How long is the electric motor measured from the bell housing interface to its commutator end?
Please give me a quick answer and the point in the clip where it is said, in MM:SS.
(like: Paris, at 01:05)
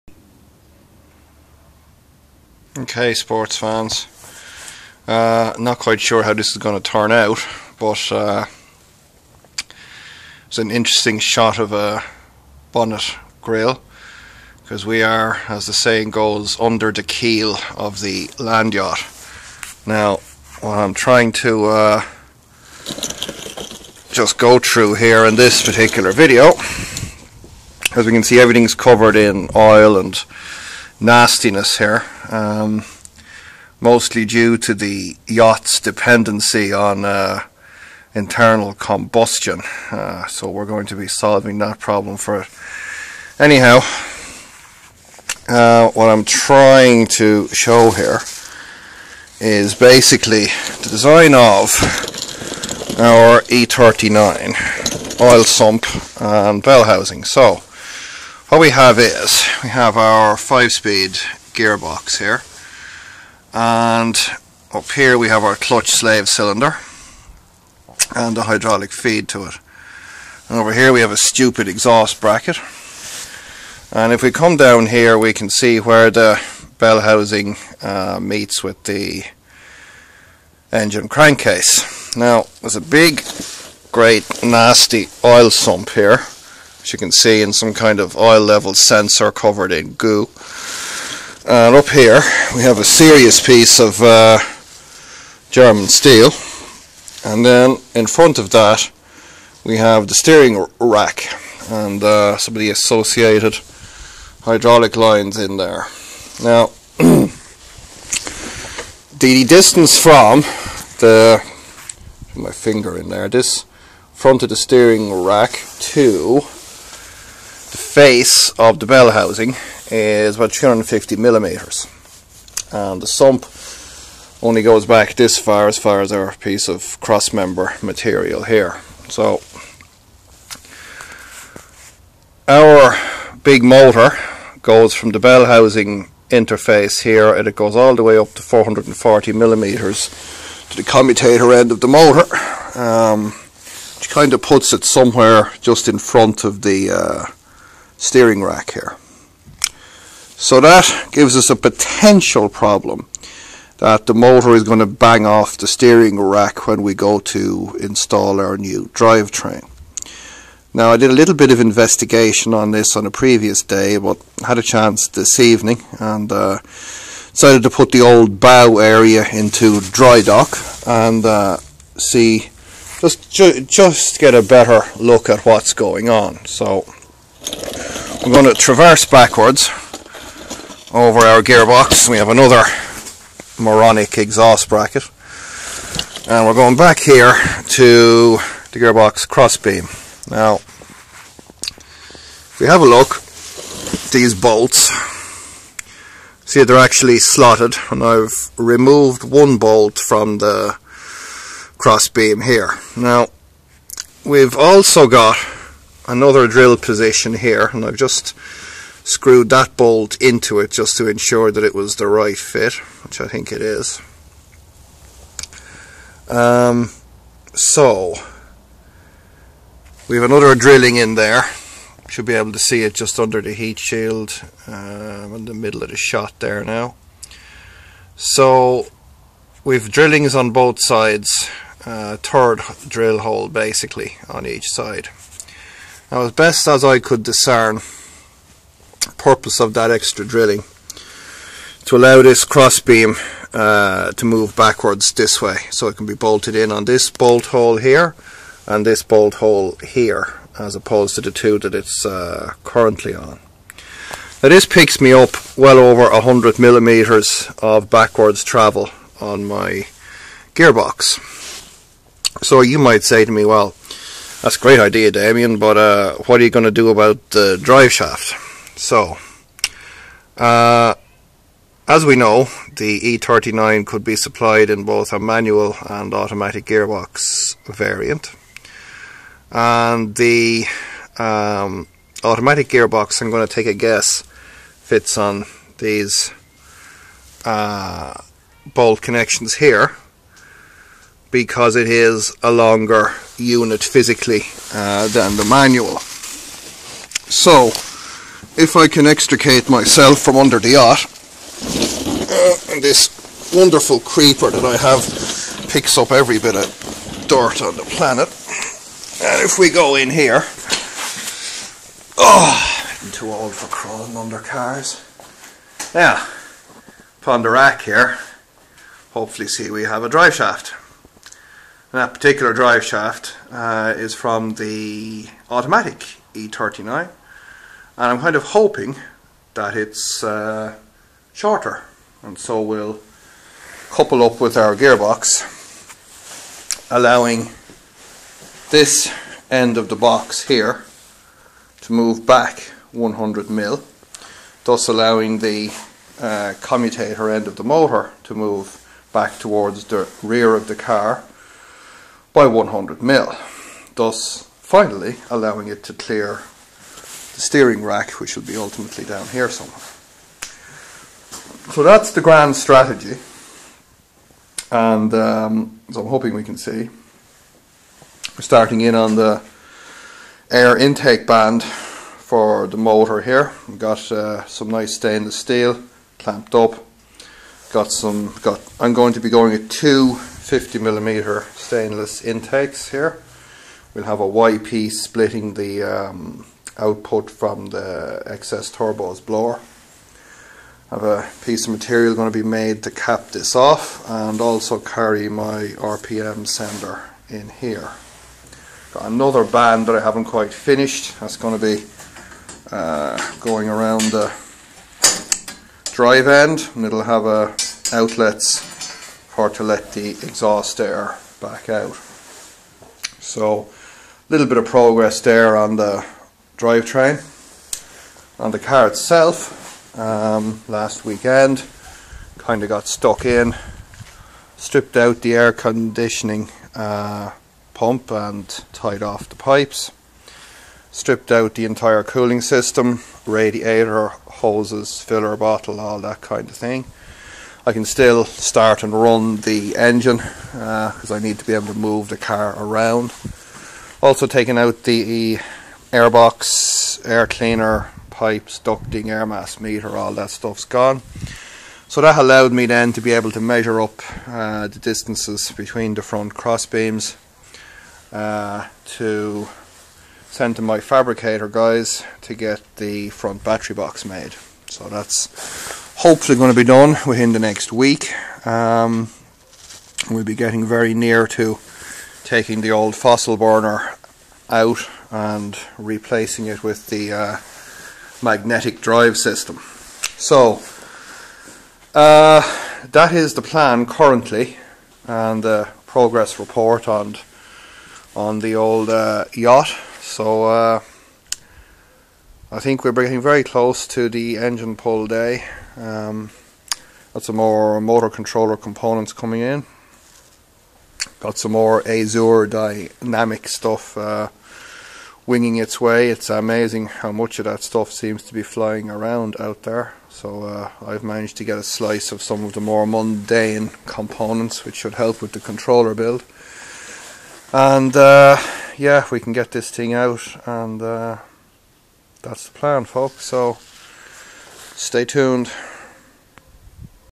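440 millimeters, at 02:18.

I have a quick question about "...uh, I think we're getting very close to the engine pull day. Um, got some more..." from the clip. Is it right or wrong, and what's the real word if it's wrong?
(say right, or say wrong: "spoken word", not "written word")
right.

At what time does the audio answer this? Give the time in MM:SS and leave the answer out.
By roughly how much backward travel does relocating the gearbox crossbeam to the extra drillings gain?
04:16.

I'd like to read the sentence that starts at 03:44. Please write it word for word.
Um, in the middle of the shot there now.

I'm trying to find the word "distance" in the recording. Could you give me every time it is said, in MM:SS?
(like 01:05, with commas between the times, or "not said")
01:49, 07:34.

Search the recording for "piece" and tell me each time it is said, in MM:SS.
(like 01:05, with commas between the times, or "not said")
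01:33, 02:06, 06:31.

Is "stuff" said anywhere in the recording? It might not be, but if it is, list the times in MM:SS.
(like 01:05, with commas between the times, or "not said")
07:30, 08:23, 08:27.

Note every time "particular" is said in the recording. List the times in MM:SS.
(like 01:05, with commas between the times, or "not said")
00:25, 05:22.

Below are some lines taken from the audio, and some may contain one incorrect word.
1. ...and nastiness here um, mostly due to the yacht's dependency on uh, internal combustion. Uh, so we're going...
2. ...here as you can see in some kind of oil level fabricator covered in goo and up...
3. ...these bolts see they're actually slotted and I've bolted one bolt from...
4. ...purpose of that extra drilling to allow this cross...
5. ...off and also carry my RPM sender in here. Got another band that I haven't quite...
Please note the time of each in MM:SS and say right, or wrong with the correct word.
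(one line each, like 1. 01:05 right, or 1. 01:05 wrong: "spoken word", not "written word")
1. 00:29 right
2. 01:25 wrong: "sensor", not "fabricator"
3. 03:14 wrong: "removed", not "bolted"
4. 03:59 right
5. 06:33 right.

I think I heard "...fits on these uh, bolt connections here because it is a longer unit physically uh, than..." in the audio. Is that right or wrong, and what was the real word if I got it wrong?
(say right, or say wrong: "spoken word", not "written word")
right.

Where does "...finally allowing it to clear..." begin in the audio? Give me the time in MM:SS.
05:54.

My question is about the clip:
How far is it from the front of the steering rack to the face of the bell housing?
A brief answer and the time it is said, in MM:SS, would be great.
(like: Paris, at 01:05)
250 millimeters, at 02:00.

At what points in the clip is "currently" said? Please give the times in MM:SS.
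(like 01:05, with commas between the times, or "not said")
04:12, 08:03.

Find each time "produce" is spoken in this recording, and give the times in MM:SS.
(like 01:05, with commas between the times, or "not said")
not said.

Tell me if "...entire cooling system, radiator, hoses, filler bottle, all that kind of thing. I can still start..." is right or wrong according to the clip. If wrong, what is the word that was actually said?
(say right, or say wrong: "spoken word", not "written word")
right.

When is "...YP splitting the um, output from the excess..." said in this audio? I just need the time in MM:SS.
06:24.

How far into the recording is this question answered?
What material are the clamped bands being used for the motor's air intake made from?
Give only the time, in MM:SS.
06:14.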